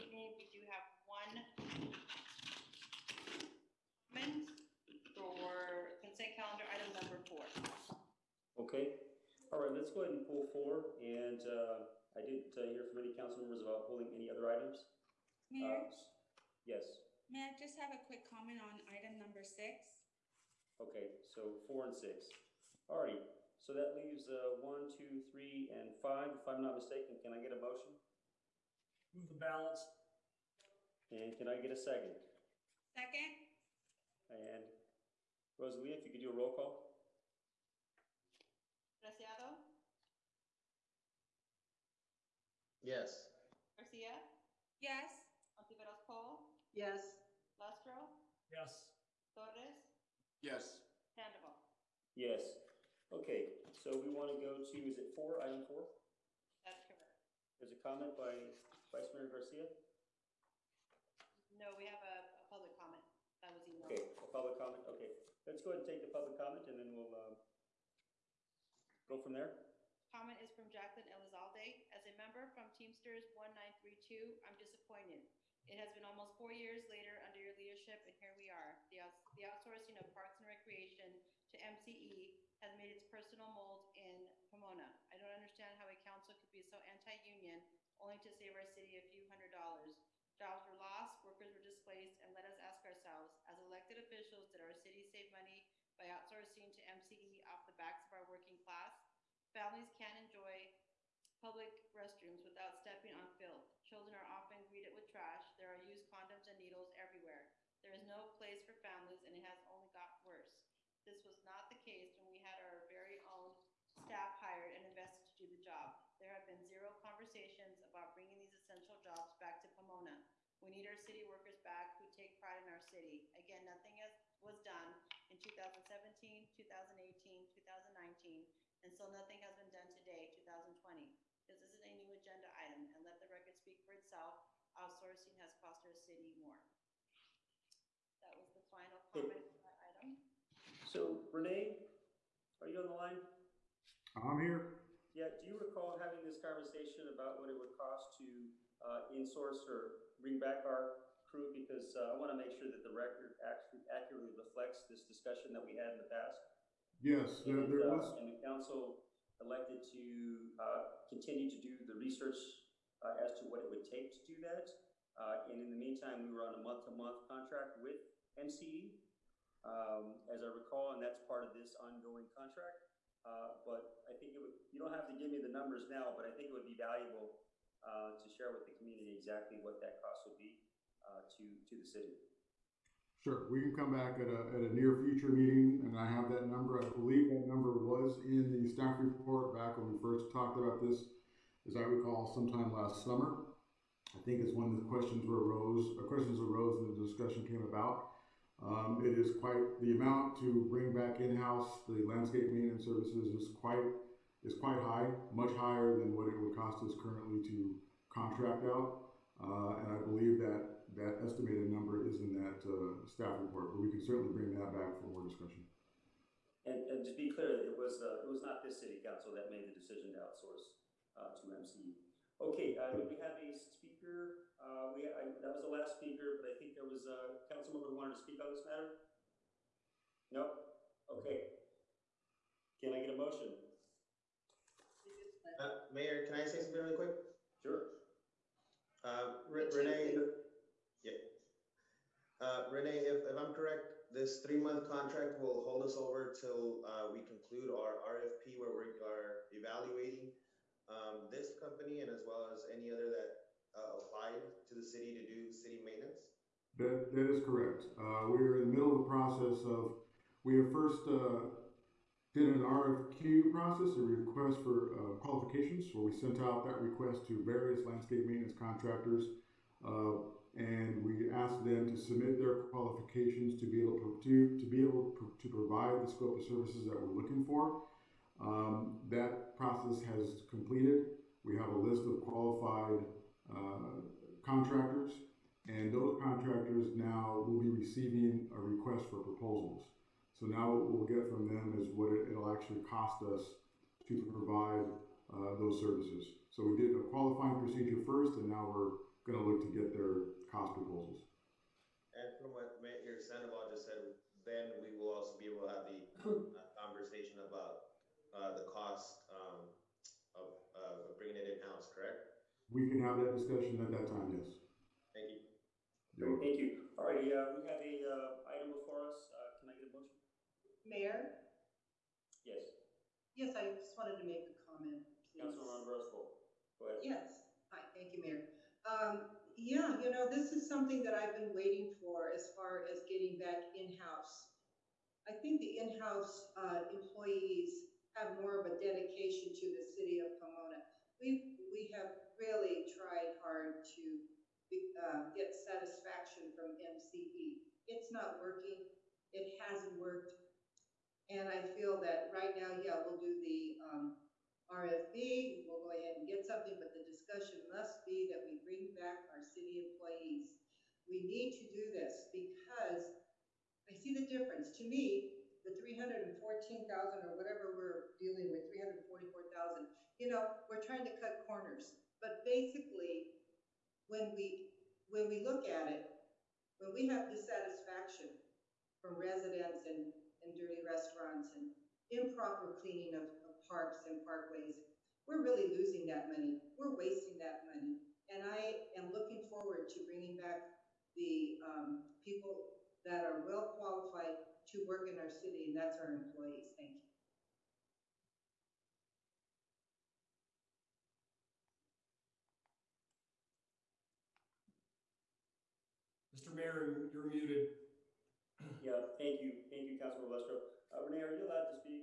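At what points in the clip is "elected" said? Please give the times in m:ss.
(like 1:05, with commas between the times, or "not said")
1:33, 2:39.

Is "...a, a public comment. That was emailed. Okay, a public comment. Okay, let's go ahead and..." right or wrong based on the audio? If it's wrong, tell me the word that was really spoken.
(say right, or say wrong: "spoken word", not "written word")
right.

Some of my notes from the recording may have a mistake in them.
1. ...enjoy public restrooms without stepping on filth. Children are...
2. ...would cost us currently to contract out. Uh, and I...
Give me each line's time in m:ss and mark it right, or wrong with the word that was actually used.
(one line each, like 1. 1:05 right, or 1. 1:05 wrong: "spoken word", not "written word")
1. 1:40 right
2. 3:26 right.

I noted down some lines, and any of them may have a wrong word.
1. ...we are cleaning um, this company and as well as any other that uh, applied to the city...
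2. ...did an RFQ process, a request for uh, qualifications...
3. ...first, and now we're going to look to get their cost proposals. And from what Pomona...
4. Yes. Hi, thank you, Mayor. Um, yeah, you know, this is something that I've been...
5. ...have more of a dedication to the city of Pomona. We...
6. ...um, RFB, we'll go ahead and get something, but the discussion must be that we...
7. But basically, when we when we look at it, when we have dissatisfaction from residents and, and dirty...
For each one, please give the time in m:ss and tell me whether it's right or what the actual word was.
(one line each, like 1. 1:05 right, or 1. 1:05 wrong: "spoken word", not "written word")
1. 4:08 wrong: "evaluating", not "cleaning"
2. 4:22 right
3. 4:58 wrong: "Mayor", not "Pomona"
4. 5:27 right
5. 5:38 right
6. 5:53 right
7. 6:12 right.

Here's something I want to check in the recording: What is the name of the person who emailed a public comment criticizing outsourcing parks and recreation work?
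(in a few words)
Jacqueline Elizalde.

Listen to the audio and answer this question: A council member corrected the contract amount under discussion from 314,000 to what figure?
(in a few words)
344,000.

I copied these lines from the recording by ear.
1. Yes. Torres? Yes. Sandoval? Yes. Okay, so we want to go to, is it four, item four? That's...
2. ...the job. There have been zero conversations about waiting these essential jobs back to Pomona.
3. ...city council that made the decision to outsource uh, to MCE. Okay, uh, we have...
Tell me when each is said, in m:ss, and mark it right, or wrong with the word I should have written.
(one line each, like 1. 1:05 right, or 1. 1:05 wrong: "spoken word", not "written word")
1. 0:48 right
2. 1:55 wrong: "bringing", not "waiting"
3. 3:38 right.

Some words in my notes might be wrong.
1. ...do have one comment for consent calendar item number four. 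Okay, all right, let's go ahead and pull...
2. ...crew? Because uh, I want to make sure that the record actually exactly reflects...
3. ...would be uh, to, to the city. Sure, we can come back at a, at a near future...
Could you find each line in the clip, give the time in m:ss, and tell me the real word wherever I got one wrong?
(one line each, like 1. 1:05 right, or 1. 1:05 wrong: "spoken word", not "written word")
1. 0:00 right
2. 2:31 wrong: "accurately", not "exactly"
3. 3:00 right.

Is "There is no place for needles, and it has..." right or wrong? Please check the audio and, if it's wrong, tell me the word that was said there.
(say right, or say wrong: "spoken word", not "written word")
wrong: "families", not "needles".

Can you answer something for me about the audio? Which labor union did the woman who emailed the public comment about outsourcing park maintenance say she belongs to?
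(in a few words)
Teamsters 1932.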